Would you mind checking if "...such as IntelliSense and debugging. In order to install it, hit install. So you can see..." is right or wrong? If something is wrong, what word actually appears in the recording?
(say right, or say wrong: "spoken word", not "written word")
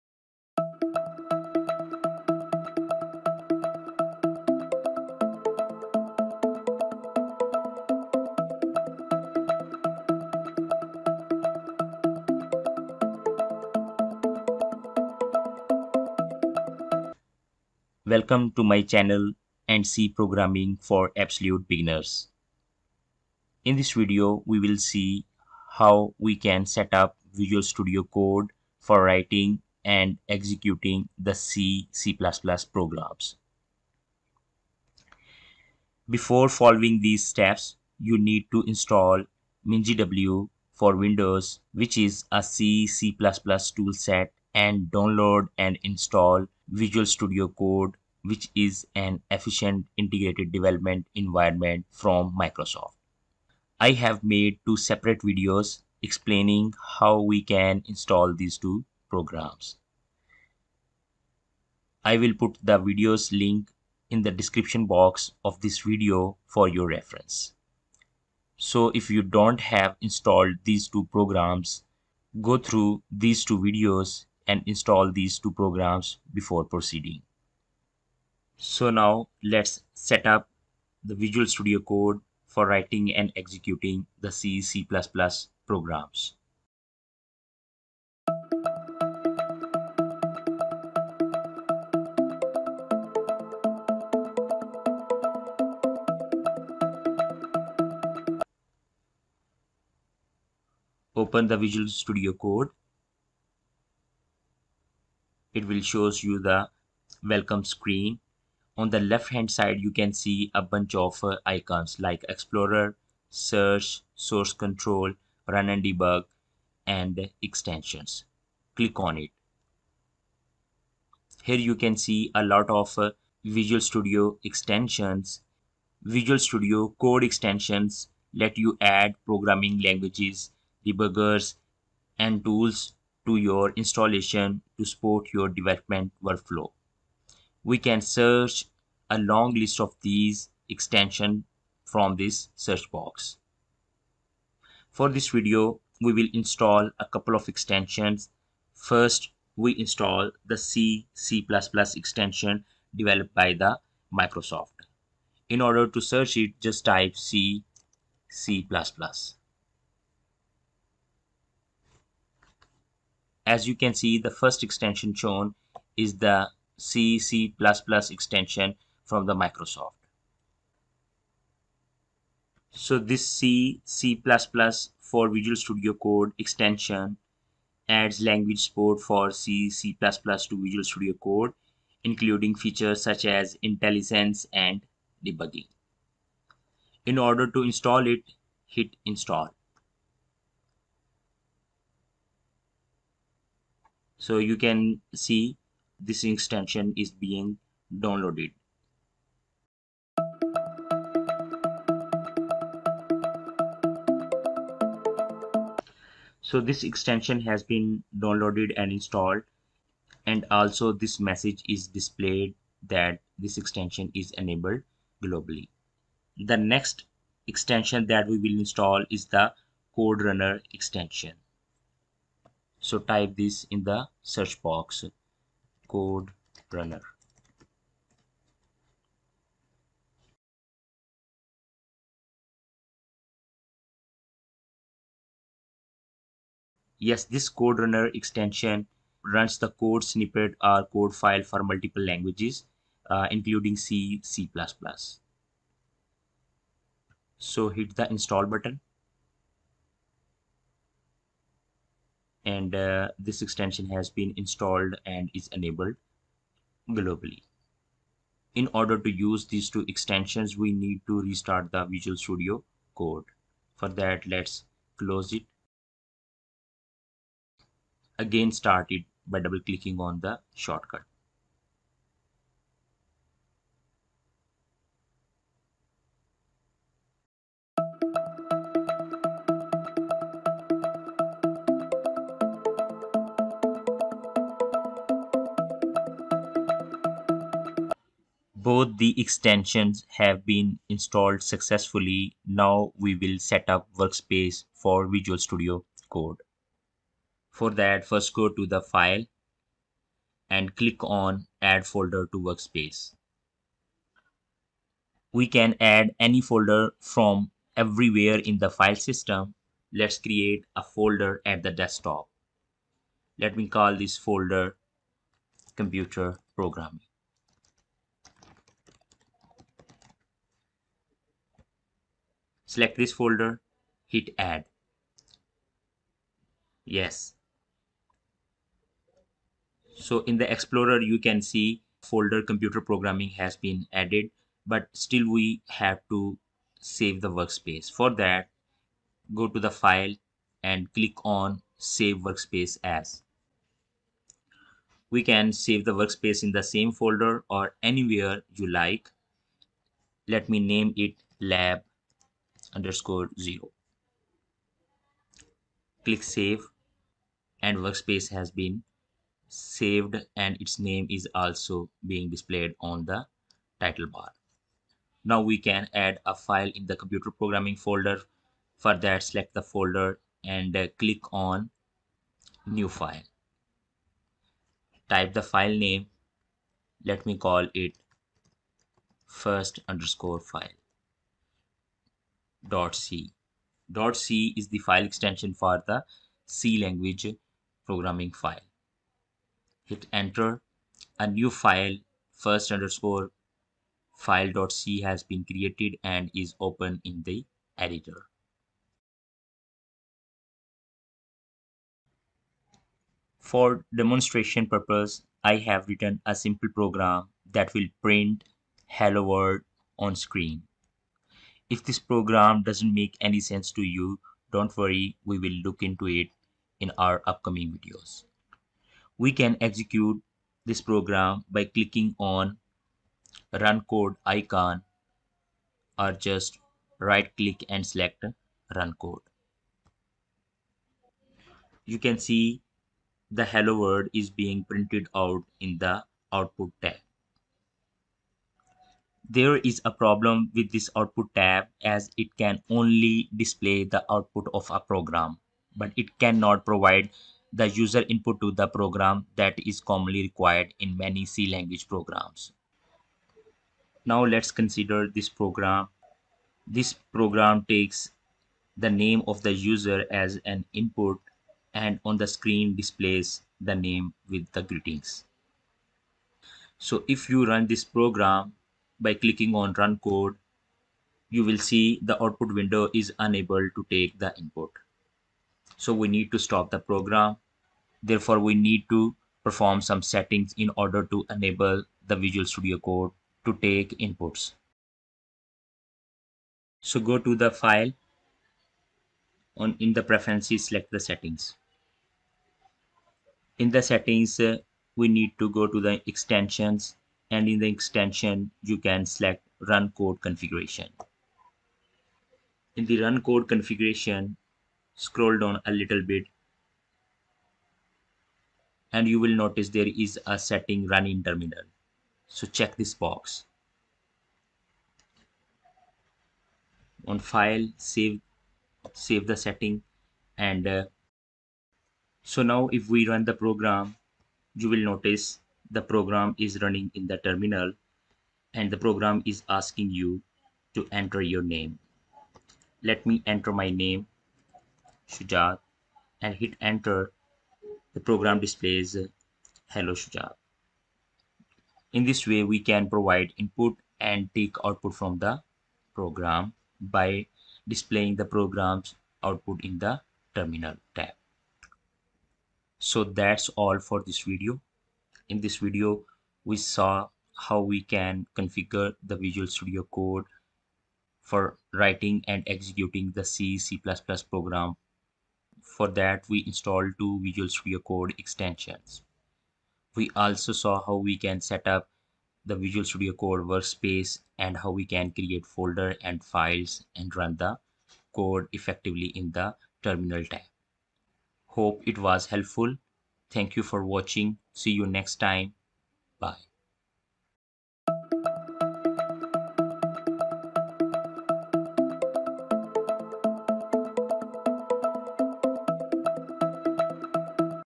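right.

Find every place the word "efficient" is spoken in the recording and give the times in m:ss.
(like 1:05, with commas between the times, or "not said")
0:49.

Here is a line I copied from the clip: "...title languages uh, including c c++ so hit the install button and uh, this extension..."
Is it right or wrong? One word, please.
wrong.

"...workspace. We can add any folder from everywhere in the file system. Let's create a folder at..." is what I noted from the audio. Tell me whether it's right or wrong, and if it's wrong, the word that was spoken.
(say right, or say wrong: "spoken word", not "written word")
right.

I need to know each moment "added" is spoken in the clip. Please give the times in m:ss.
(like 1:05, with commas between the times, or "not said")
5:33.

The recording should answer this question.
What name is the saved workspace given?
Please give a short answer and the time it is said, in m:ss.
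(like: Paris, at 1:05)
lab_0, at 5:51.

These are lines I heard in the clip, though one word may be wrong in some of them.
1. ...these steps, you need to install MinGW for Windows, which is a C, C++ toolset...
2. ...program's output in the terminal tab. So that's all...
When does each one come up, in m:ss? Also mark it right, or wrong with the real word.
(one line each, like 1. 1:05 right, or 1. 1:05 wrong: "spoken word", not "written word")
1. 0:36 right
2. 9:08 right.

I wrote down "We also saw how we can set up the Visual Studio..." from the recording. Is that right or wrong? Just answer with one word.
right.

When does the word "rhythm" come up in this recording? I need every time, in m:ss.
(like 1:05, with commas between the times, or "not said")
not said.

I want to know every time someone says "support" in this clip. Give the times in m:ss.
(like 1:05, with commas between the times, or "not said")
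2:14, 2:58.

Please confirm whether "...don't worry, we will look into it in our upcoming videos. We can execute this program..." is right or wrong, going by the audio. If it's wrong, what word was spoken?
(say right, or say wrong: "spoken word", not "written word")
right.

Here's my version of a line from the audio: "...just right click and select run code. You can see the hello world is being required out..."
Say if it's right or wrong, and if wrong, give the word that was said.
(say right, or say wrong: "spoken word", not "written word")
wrong: "printed", not "required".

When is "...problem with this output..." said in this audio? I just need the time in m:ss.
7:19.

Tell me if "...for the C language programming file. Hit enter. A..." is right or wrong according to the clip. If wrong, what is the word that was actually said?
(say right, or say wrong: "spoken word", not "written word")
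right.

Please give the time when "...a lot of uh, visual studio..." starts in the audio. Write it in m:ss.
2:02.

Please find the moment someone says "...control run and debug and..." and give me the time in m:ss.
1:54.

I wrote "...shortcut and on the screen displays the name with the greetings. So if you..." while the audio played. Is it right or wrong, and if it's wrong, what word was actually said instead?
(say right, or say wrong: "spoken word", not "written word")
wrong: "input", not "shortcut".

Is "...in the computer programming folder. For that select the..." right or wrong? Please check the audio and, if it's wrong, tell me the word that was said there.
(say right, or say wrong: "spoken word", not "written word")
right.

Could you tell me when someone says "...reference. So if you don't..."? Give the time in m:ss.
1:06.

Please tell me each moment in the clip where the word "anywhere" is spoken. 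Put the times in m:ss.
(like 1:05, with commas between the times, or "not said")
5:47.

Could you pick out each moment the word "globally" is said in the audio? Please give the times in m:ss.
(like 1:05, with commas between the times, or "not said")
3:35, 4:16.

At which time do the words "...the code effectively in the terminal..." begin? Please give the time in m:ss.
9:37.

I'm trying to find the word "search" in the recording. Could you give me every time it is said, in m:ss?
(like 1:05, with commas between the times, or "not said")
1:53, 2:18, 2:22, 2:36, 3:44.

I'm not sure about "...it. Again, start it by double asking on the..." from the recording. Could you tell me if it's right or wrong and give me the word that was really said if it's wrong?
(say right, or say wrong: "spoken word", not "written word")
wrong: "clicking", not "asking".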